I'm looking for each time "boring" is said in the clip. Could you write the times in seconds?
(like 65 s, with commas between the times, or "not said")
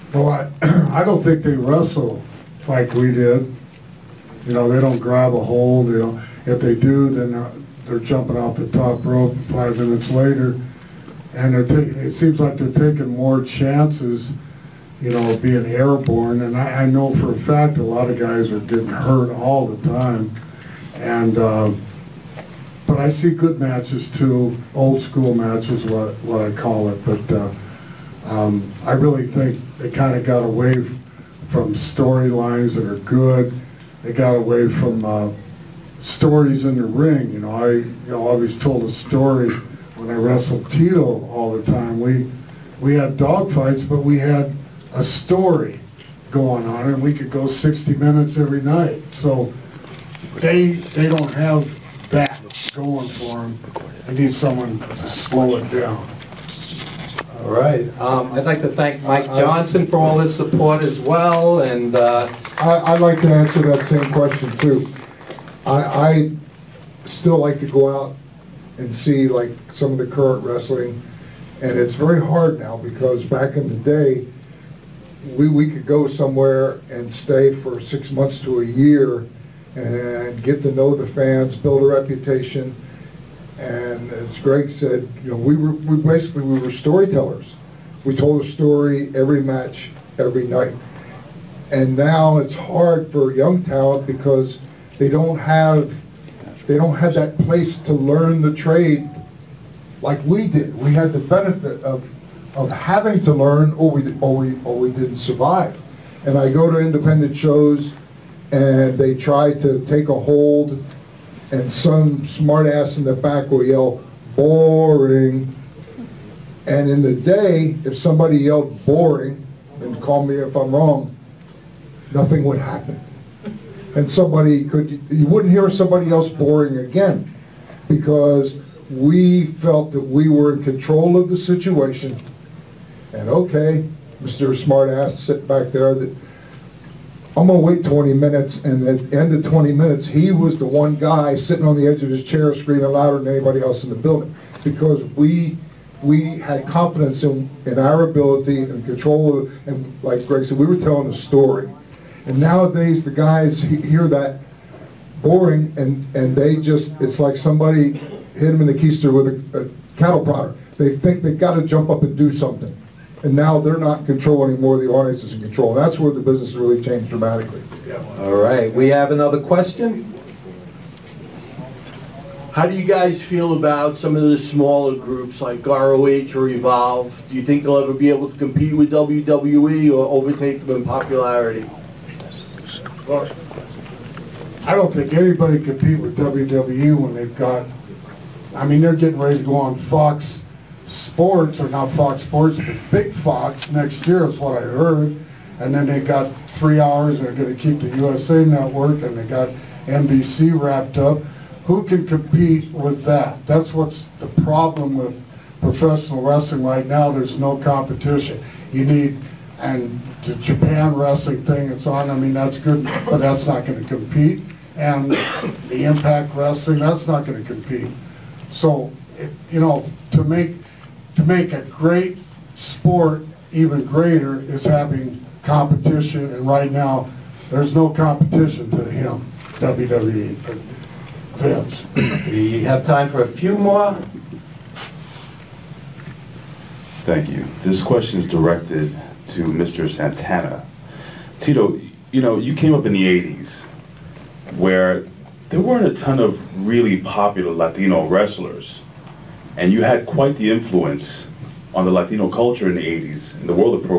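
114 s, 118 s, 126 s, 155 s.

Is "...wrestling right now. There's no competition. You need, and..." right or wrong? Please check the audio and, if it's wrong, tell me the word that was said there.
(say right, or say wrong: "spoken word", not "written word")
right.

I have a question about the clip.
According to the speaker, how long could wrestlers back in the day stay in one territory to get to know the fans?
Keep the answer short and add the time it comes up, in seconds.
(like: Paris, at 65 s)
6 months to a year, at 77 s.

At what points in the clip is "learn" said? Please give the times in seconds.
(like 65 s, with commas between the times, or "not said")
97 s, 103 s.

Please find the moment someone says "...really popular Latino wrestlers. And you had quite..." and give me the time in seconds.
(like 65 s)
246 s.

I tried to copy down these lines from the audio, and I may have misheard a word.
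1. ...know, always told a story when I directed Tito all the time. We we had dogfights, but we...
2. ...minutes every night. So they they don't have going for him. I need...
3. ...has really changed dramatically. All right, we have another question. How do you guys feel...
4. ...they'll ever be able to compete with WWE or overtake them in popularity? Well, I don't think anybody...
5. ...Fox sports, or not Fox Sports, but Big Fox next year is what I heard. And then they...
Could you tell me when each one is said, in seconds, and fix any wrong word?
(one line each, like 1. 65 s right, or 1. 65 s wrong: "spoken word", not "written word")
1. 38 s wrong: "wrestled", not "directed"
2. 47 s right
3. 166 s right
4. 177 s right
5. 189 s right.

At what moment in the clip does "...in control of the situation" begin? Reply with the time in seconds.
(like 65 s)
130 s.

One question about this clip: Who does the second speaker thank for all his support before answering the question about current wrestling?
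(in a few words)
Mike Johnson.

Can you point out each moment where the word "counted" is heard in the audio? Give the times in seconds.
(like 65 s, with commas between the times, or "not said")
not said.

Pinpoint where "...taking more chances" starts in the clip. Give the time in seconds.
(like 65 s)
12 s.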